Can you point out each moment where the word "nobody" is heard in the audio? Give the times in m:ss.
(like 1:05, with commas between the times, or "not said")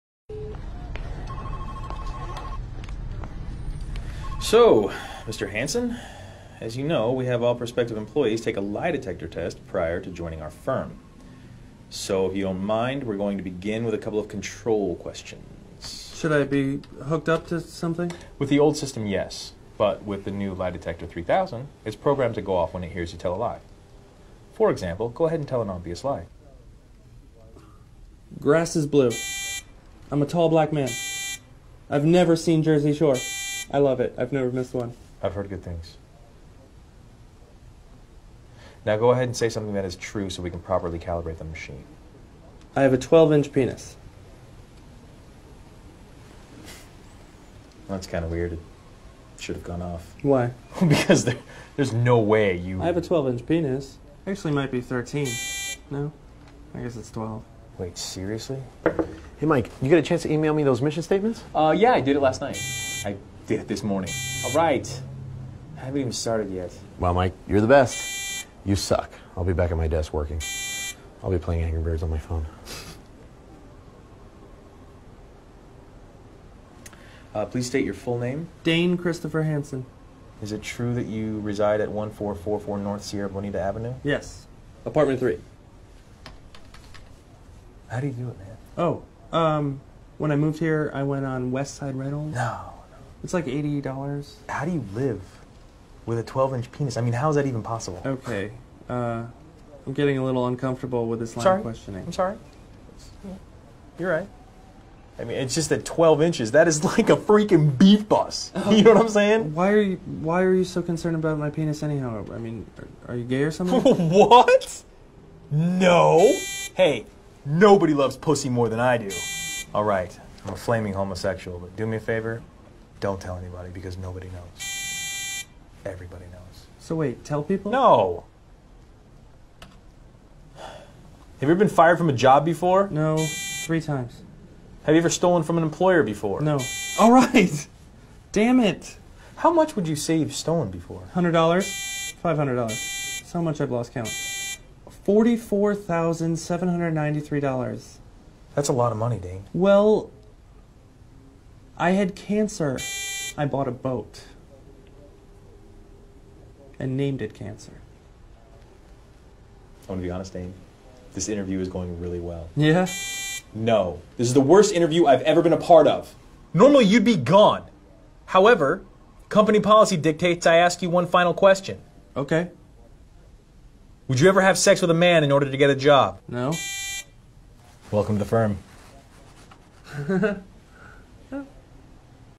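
1:57, 2:03.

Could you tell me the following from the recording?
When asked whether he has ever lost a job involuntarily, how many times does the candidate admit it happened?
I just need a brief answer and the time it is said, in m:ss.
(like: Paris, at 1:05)
3 times, at 2:13.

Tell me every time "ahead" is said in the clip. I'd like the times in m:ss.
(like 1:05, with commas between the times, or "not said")
0:25, 0:39.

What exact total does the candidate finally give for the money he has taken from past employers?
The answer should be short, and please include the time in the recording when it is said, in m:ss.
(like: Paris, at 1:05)
$44,793, at 2:25.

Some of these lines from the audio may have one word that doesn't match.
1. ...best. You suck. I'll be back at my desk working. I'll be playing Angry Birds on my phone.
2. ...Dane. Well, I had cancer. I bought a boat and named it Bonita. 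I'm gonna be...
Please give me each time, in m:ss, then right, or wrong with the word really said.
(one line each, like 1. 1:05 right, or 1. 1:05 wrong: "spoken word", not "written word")
1. 1:07 right
2. 2:29 wrong: "Cancer", not "Bonita".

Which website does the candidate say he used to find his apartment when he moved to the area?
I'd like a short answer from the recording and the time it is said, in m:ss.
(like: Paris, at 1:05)
West Side Rentals, at 1:31.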